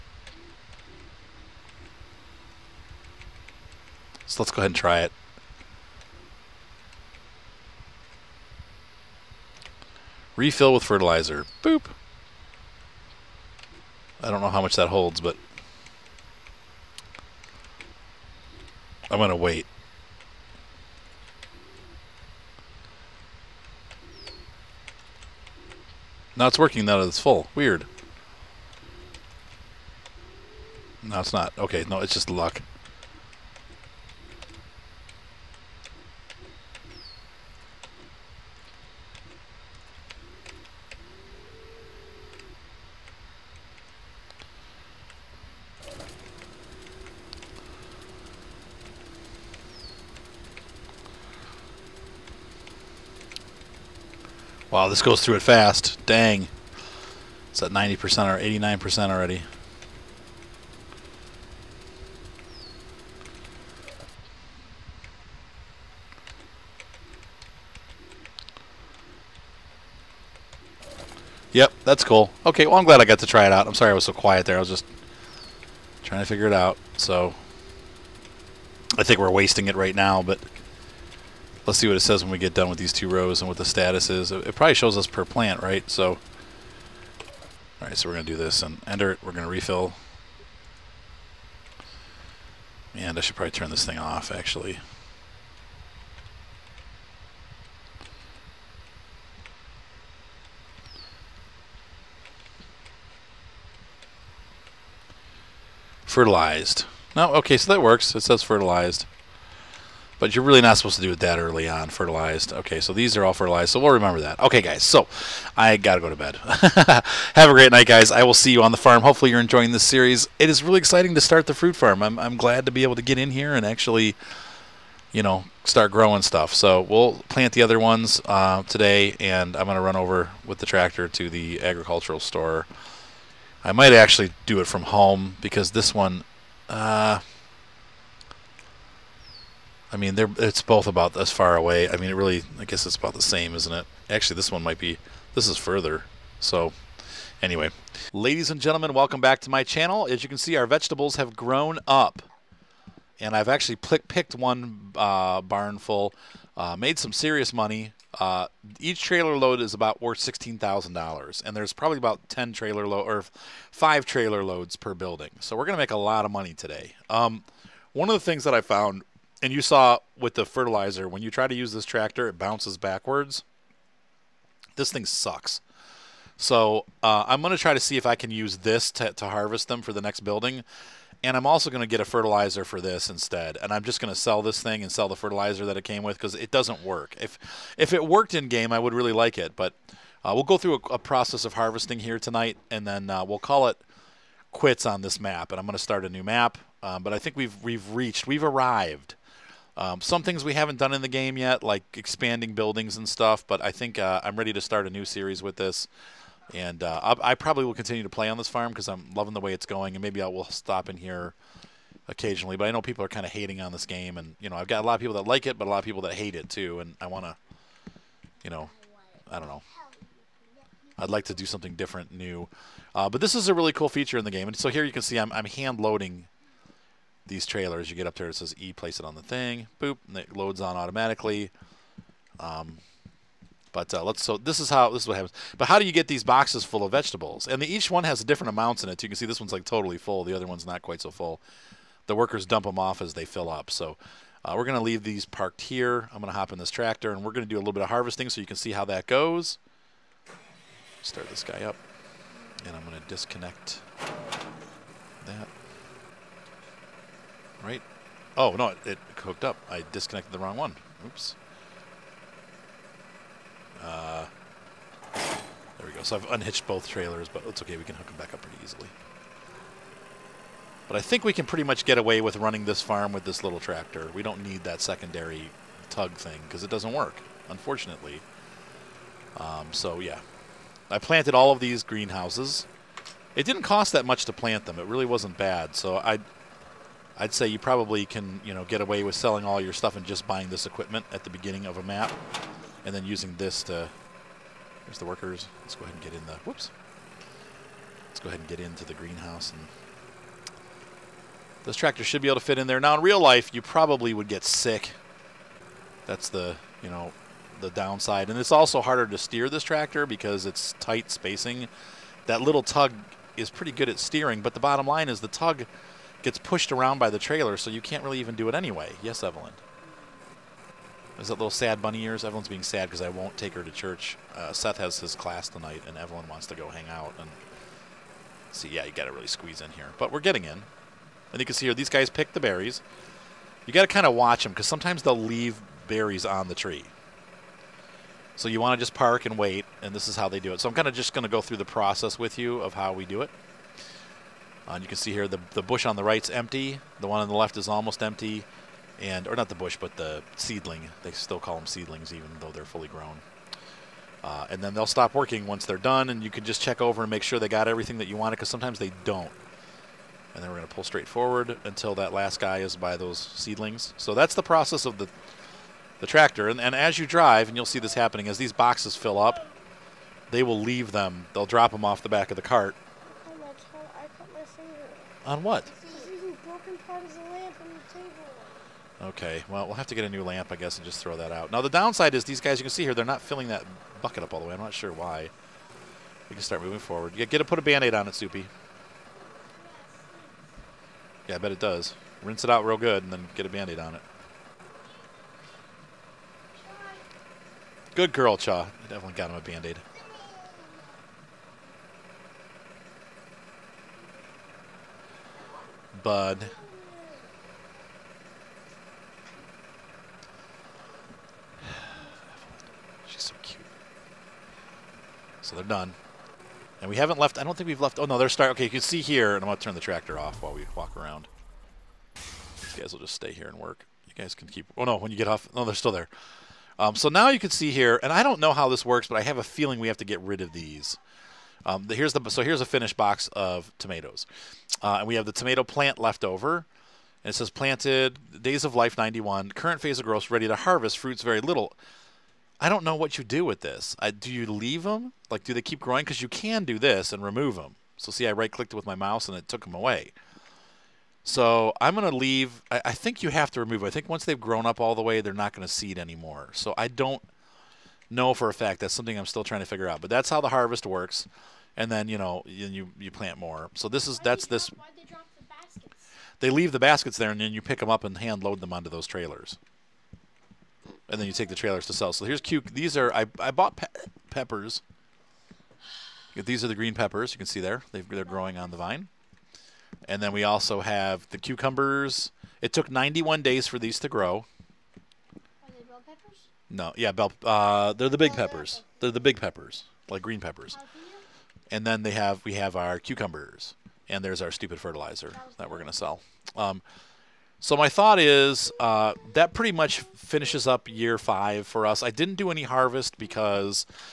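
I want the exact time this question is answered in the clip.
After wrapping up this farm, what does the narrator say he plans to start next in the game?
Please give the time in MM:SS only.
03:16.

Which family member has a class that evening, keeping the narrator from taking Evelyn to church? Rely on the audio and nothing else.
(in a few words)
Seth.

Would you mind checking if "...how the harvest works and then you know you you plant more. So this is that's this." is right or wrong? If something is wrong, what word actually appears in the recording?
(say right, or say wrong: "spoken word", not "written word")
right.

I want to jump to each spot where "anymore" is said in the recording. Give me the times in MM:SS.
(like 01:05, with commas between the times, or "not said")
07:35.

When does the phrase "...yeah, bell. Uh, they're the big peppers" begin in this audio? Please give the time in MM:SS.
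08:06.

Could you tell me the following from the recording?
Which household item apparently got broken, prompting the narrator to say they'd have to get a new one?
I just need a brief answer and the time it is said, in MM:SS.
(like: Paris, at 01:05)
Lamp, at 06:20.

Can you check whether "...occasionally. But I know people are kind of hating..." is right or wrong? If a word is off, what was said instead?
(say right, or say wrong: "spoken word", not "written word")
right.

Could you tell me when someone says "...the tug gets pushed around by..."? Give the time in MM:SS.
05:15.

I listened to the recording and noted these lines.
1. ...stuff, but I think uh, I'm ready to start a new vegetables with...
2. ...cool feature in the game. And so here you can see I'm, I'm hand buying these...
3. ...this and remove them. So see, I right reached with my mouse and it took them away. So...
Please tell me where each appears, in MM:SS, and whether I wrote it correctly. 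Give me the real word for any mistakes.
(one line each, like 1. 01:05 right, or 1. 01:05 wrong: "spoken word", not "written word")
1. 03:23 wrong: "series", not "vegetables"
2. 03:43 wrong: "loading", not "buying"
3. 07:26 wrong: "clicked", not "reached".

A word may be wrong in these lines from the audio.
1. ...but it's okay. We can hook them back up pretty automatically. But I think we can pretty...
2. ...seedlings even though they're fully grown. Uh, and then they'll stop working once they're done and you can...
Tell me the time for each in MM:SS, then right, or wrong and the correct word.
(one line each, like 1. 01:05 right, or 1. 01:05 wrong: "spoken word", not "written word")
1. 04:27 wrong: "easily", not "automatically"
2. 05:51 right.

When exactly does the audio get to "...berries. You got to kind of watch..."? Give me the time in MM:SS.
05:32.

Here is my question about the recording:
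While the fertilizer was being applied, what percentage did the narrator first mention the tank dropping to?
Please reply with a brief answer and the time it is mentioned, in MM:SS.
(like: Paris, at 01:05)
90%, at 00:57.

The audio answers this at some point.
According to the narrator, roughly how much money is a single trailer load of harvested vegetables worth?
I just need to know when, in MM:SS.
02:40.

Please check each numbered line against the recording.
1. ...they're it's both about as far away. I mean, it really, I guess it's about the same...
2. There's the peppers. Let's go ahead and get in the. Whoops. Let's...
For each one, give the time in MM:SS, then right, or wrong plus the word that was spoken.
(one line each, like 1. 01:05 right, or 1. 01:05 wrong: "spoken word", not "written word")
1. 02:20 right
2. 04:54 wrong: "workers", not "peppers".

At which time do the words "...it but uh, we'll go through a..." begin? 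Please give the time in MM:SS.
03:09.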